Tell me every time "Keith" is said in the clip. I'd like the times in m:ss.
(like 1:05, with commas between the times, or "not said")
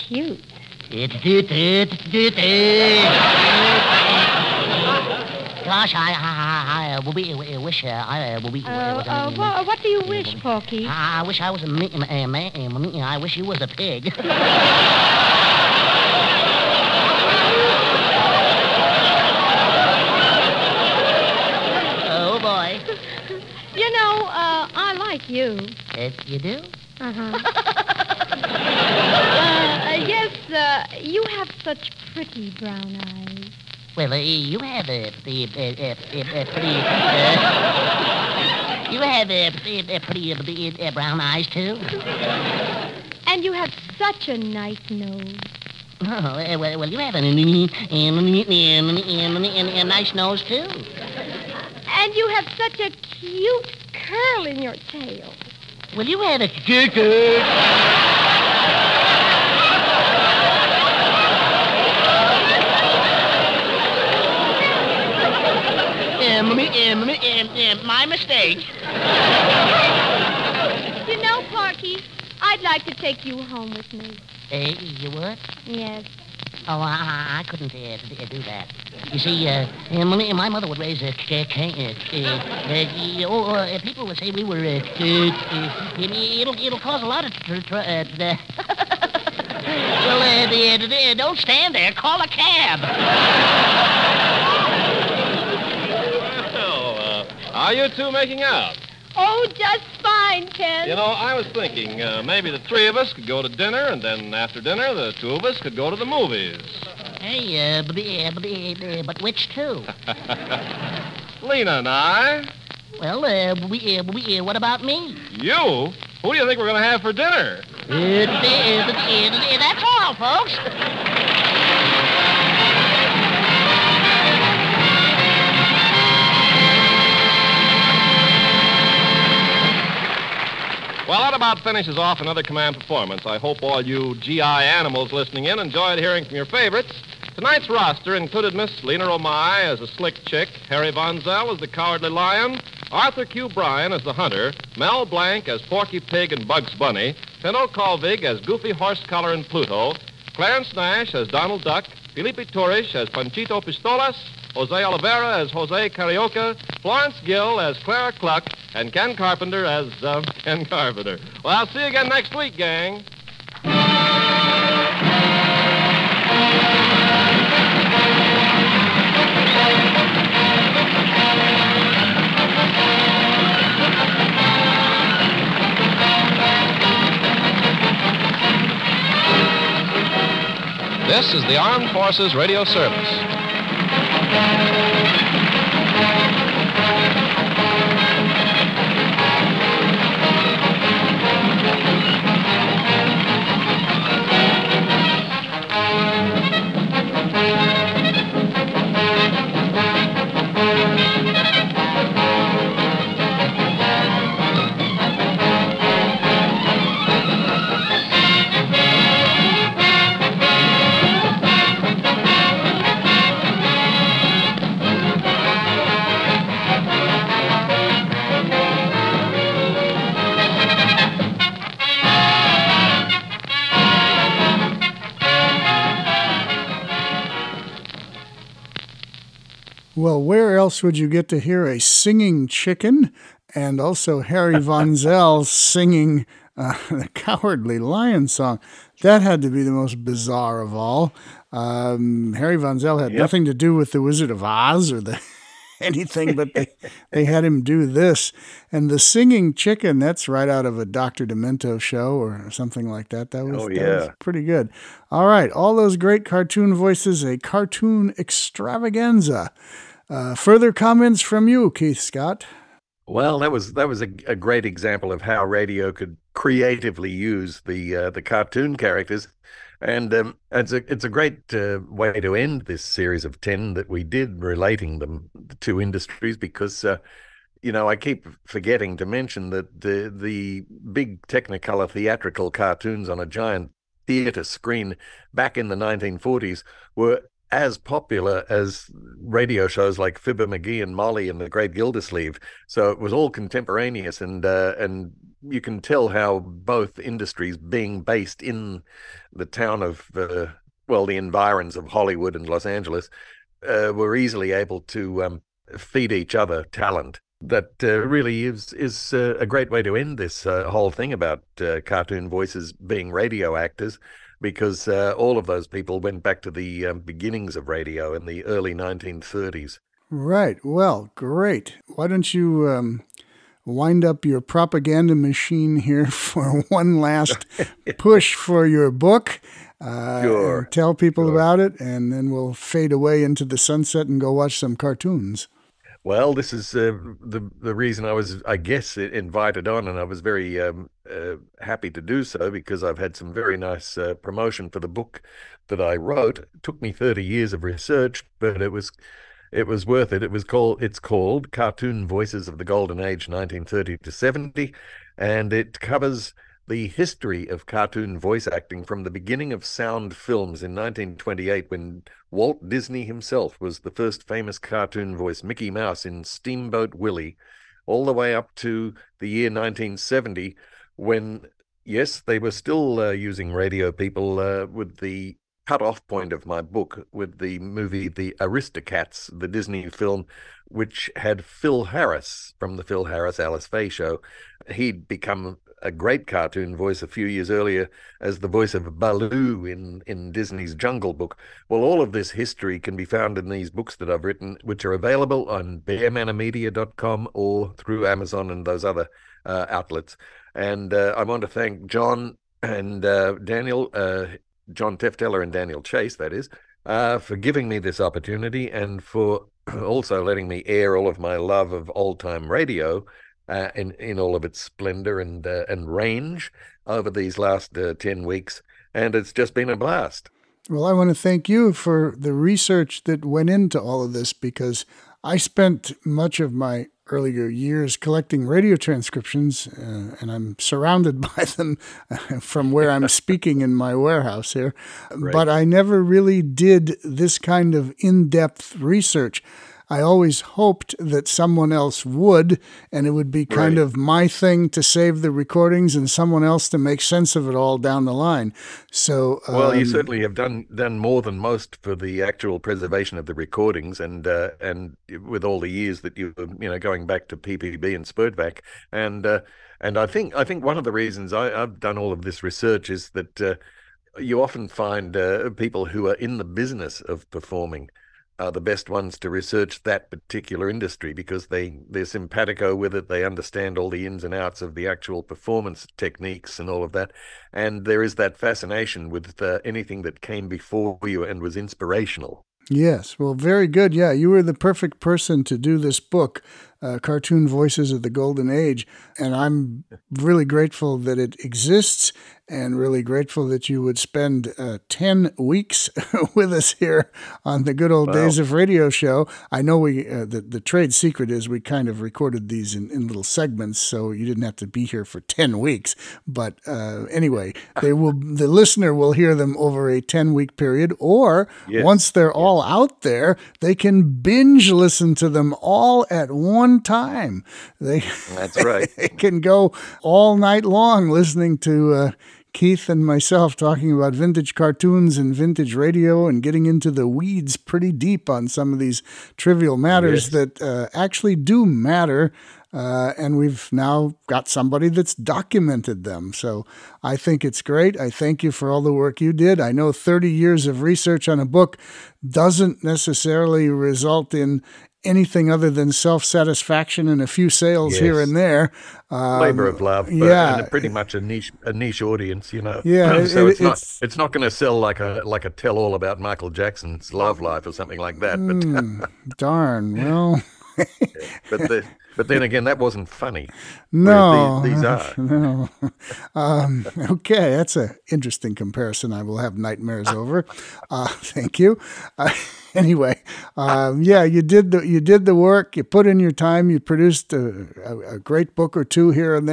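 4:21, 8:42.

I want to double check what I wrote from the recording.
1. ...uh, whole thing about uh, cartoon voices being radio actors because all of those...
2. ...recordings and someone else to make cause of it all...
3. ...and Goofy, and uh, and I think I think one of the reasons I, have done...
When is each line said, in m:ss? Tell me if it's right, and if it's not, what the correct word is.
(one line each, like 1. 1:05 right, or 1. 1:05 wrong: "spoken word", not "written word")
1. 5:10 right
2. 7:25 wrong: "sense", not "cause"
3. 7:37 wrong: "Spurtback", not "Goofy".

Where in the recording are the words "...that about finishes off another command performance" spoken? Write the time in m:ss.
2:11.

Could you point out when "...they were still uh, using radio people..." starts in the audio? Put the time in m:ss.
6:12.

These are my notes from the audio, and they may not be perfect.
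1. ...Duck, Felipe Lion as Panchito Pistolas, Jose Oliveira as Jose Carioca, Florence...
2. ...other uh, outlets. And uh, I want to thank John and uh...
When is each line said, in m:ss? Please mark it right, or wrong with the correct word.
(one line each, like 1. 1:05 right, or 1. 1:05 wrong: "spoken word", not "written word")
1. 2:31 wrong: "Torres", not "Lion"
2. 6:38 right.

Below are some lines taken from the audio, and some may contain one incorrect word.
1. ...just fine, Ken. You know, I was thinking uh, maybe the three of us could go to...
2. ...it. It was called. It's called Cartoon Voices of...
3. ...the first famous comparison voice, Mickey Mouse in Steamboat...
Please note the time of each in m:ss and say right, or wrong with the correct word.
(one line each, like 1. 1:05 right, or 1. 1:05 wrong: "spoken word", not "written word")
1. 1:39 right
2. 5:50 right
3. 6:03 wrong: "cartoon", not "comparison".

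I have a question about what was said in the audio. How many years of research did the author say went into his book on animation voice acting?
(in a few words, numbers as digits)
30.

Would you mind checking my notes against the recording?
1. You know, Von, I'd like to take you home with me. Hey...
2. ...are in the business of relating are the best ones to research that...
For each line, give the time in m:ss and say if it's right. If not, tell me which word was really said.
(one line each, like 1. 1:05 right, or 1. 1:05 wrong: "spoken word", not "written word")
1. 1:11 wrong: "Porky", not "Von"
2. 7:46 wrong: "performing", not "relating".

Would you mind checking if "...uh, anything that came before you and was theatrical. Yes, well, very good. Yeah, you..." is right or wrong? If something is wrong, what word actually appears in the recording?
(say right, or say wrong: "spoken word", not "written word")
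wrong: "inspirational", not "theatrical".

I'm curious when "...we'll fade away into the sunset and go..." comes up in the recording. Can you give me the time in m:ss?
5:32.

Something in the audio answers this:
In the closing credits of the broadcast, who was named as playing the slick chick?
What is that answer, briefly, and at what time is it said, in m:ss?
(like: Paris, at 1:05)
Lena Romay, at 2:18.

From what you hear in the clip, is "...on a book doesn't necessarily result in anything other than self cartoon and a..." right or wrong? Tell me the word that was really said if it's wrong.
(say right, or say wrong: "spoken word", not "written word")
wrong: "satisfaction", not "cartoon".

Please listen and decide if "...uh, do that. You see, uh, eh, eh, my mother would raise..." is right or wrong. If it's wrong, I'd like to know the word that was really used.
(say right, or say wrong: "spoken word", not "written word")
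right.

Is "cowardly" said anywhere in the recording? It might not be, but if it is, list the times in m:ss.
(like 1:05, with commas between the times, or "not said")
2:21, 3:57.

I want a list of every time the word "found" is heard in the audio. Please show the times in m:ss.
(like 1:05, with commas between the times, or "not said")
6:33.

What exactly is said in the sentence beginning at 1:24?
Uh, it'll it'll cause a lot of.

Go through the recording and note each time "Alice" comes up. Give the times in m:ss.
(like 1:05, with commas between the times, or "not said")
6:23.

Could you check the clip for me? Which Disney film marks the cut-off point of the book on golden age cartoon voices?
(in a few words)
The Aristocats.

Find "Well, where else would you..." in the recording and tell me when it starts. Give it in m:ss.
3:49.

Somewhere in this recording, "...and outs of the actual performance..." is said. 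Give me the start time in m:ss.
7:54.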